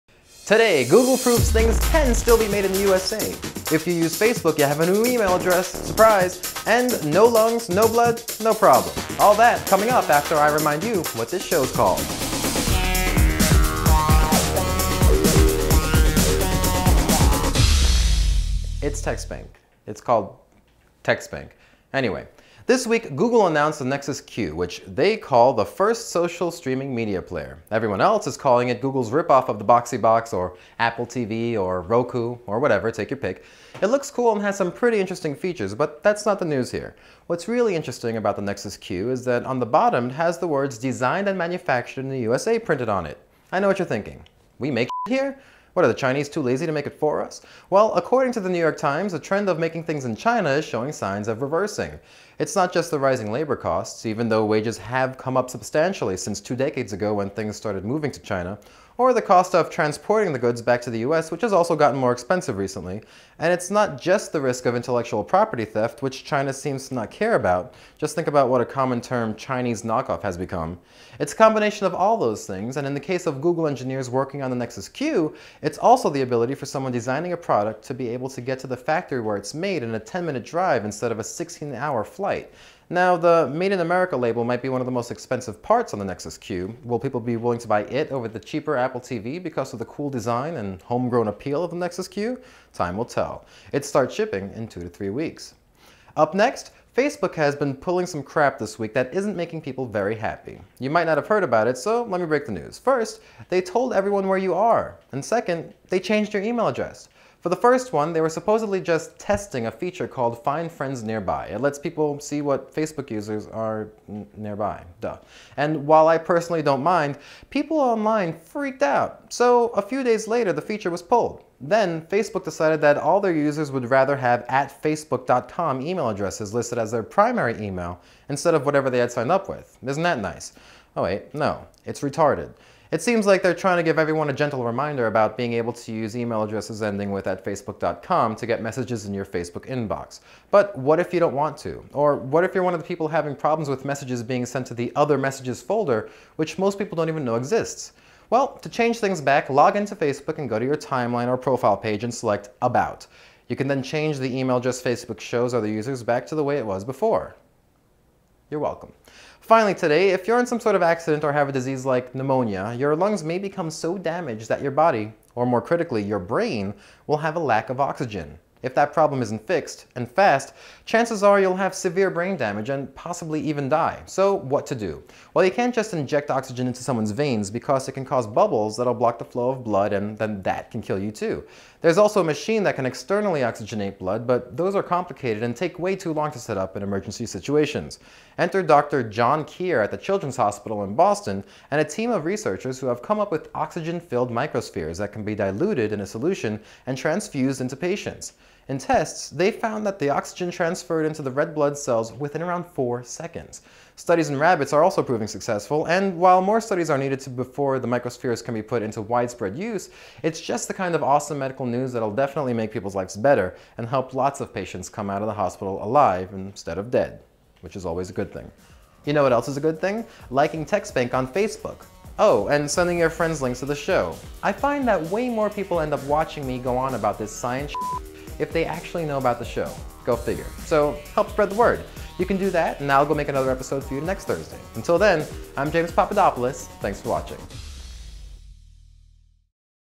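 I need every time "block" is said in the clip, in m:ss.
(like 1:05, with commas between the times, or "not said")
2:58.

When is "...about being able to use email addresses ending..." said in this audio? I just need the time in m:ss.
2:15.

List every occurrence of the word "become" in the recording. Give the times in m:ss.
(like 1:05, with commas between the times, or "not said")
1:10, 2:43.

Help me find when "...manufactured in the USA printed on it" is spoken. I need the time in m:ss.
0:41.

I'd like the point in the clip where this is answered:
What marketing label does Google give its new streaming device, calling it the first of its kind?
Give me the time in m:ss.
0:26.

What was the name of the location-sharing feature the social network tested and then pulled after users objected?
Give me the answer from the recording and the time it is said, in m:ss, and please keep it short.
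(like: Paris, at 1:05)
Find Friends Nearby, at 1:50.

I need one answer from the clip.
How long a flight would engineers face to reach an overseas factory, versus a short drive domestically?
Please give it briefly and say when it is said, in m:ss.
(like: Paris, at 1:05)
16-hour flight, at 1:21.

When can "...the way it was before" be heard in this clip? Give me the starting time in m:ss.
2:36.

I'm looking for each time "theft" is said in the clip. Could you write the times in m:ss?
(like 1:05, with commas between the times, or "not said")
1:05.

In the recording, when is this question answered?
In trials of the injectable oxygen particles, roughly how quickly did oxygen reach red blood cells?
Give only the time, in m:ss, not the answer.
3:22.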